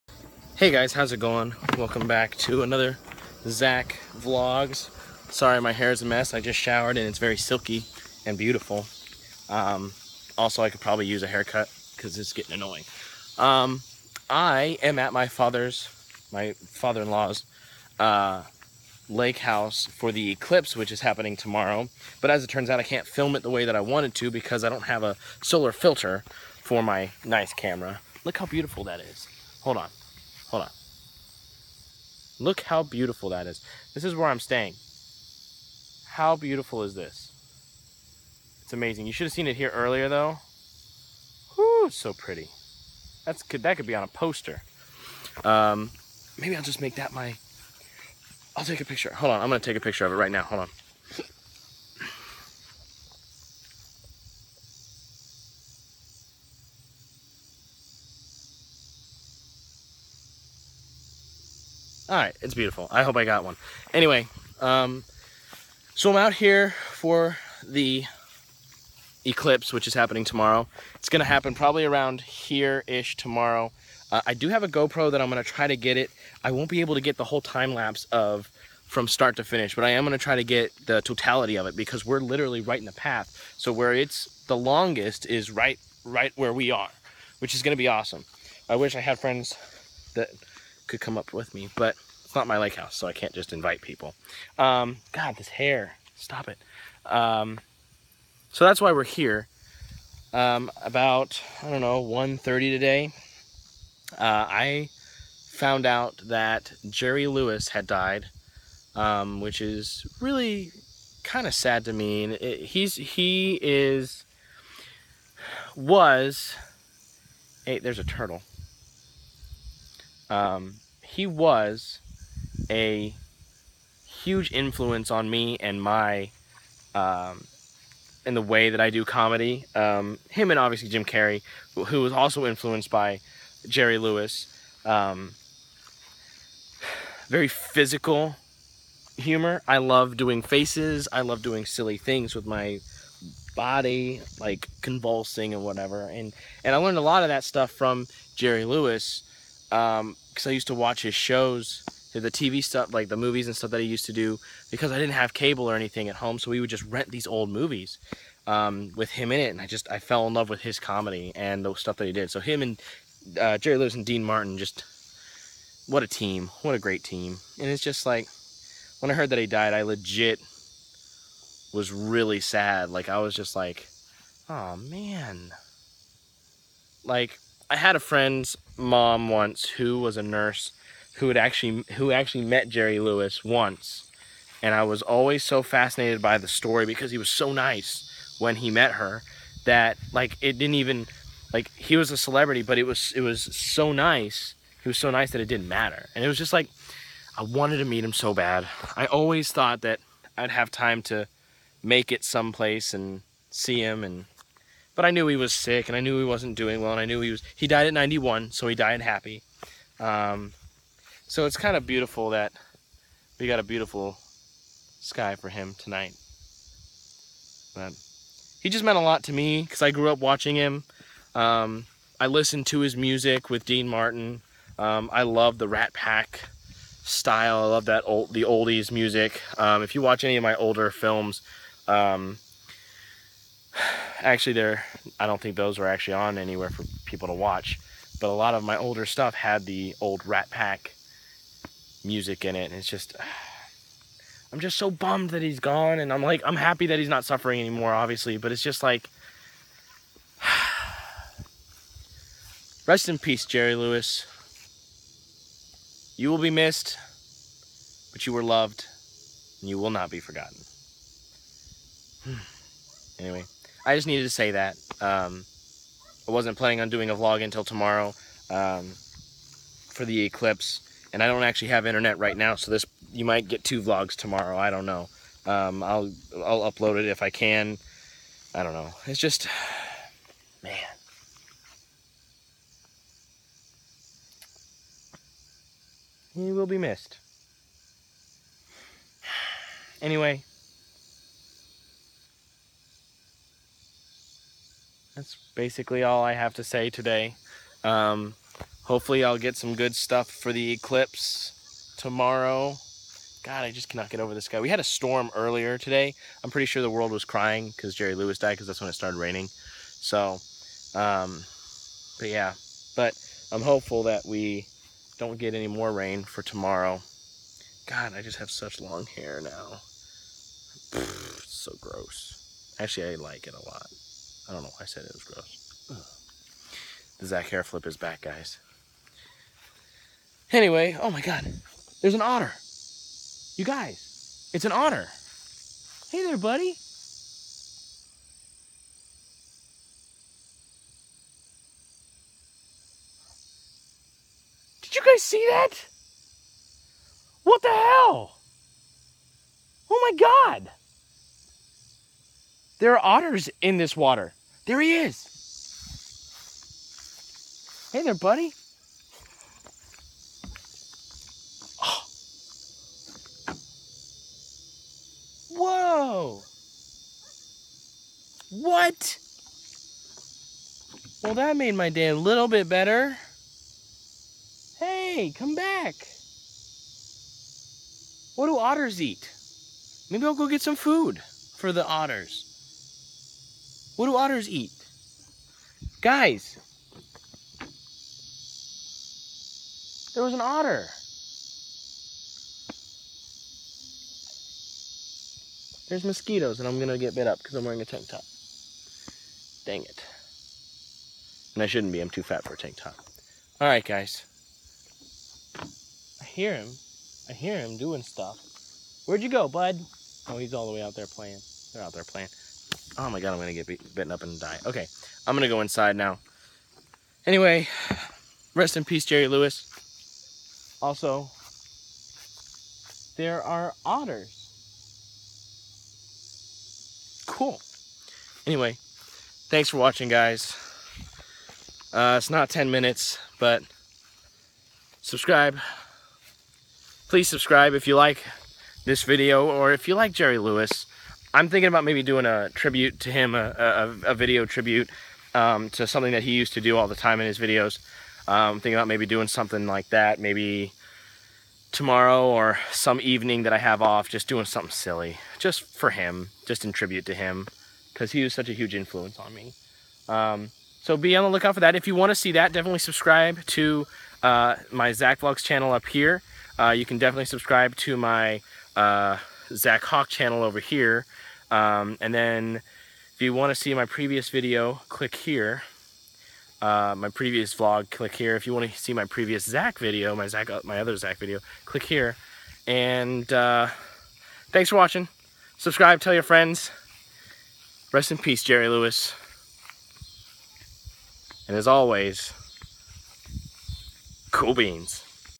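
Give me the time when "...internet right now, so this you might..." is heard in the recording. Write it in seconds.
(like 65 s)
271 s.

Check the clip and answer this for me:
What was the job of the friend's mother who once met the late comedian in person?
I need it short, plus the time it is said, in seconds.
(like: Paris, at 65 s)
nurse, at 180 s.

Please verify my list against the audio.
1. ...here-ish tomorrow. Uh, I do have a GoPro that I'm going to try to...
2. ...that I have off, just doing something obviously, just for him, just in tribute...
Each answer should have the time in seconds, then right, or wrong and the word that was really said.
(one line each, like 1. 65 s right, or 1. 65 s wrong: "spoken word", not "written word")
1. 72 s right
2. 453 s wrong: "silly", not "obviously".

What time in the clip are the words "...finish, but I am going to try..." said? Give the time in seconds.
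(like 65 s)
79 s.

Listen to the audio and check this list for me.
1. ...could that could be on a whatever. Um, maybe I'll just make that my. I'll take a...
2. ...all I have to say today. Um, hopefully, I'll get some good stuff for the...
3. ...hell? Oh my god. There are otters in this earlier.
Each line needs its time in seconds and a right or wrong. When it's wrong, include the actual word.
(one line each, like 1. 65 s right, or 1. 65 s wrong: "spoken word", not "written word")
1. 43 s wrong: "poster", not "whatever"
2. 296 s right
3. 347 s wrong: "water", not "earlier".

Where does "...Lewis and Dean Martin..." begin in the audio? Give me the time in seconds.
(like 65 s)
163 s.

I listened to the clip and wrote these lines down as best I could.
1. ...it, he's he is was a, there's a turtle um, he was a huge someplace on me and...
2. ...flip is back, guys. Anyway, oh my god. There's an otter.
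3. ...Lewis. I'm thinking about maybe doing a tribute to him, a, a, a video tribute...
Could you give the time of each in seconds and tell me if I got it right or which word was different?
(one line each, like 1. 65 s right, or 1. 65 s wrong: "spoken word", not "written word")
1. 112 s wrong: "influence", not "someplace"
2. 327 s right
3. 440 s right.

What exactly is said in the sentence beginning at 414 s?
Okay, I'm gonna go inside now.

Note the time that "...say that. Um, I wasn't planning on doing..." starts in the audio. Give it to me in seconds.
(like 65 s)
264 s.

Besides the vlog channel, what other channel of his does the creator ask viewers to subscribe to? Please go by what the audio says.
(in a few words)
Zakhawk.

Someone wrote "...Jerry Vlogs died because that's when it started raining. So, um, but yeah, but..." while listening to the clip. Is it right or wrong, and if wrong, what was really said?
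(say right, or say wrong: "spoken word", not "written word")
wrong: "Lewis", not "Vlogs".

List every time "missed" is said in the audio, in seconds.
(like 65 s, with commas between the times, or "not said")
256 s, 286 s.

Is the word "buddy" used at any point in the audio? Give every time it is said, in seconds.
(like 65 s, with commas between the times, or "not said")
336 s, 358 s.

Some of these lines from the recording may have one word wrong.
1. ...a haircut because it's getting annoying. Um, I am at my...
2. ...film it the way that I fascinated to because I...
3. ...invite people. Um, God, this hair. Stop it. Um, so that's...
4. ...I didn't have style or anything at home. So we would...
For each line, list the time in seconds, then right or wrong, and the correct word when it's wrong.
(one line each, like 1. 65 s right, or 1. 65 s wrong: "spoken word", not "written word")
1. 11 s right
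2. 23 s wrong: "wanted", not "fascinated"
3. 93 s right
4. 154 s wrong: "cable", not "style".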